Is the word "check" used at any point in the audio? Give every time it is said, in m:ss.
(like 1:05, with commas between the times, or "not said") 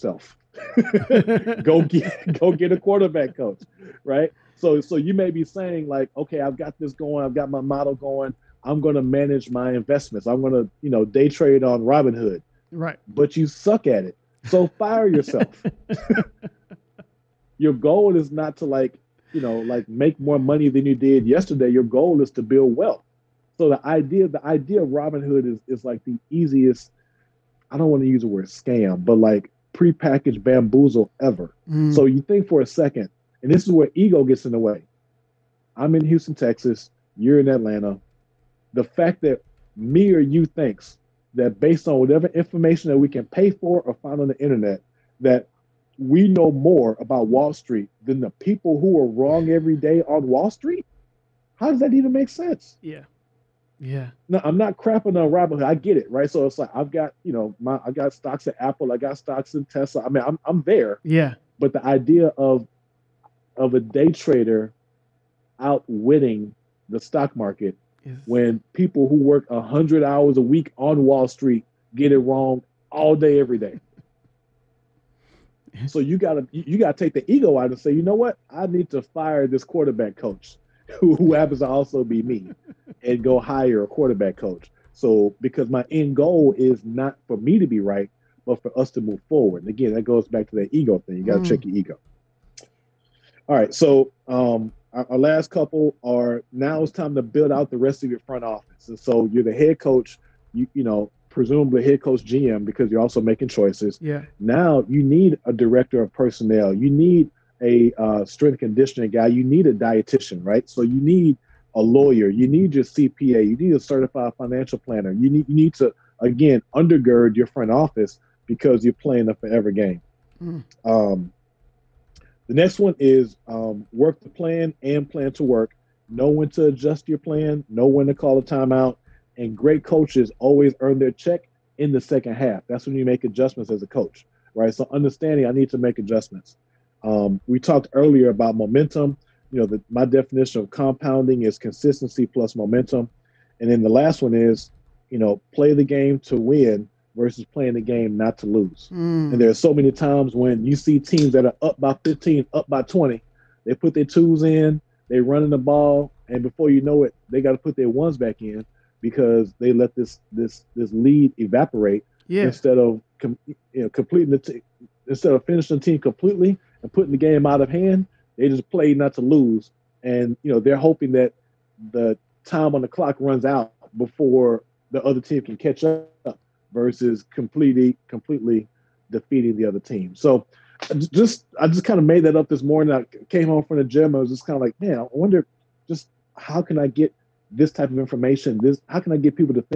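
1:31, 2:11.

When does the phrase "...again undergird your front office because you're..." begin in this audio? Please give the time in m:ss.
1:56.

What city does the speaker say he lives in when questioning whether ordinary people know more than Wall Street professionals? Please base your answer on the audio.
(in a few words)
Houston, Texas.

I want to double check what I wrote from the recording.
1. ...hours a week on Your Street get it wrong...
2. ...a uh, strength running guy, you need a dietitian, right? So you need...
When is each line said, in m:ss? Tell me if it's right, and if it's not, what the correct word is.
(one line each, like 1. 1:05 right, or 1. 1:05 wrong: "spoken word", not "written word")
1. 1:10 wrong: "Wall", not "Your"
2. 1:47 wrong: "conditioning", not "running".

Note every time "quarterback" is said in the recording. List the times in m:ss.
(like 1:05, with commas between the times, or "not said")
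0:02, 1:19, 1:23.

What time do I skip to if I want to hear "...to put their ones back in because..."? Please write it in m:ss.
2:37.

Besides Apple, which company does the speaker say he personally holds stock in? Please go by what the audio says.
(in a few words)
Tesla.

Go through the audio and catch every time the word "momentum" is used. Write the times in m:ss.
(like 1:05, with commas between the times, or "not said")
2:18, 2:22.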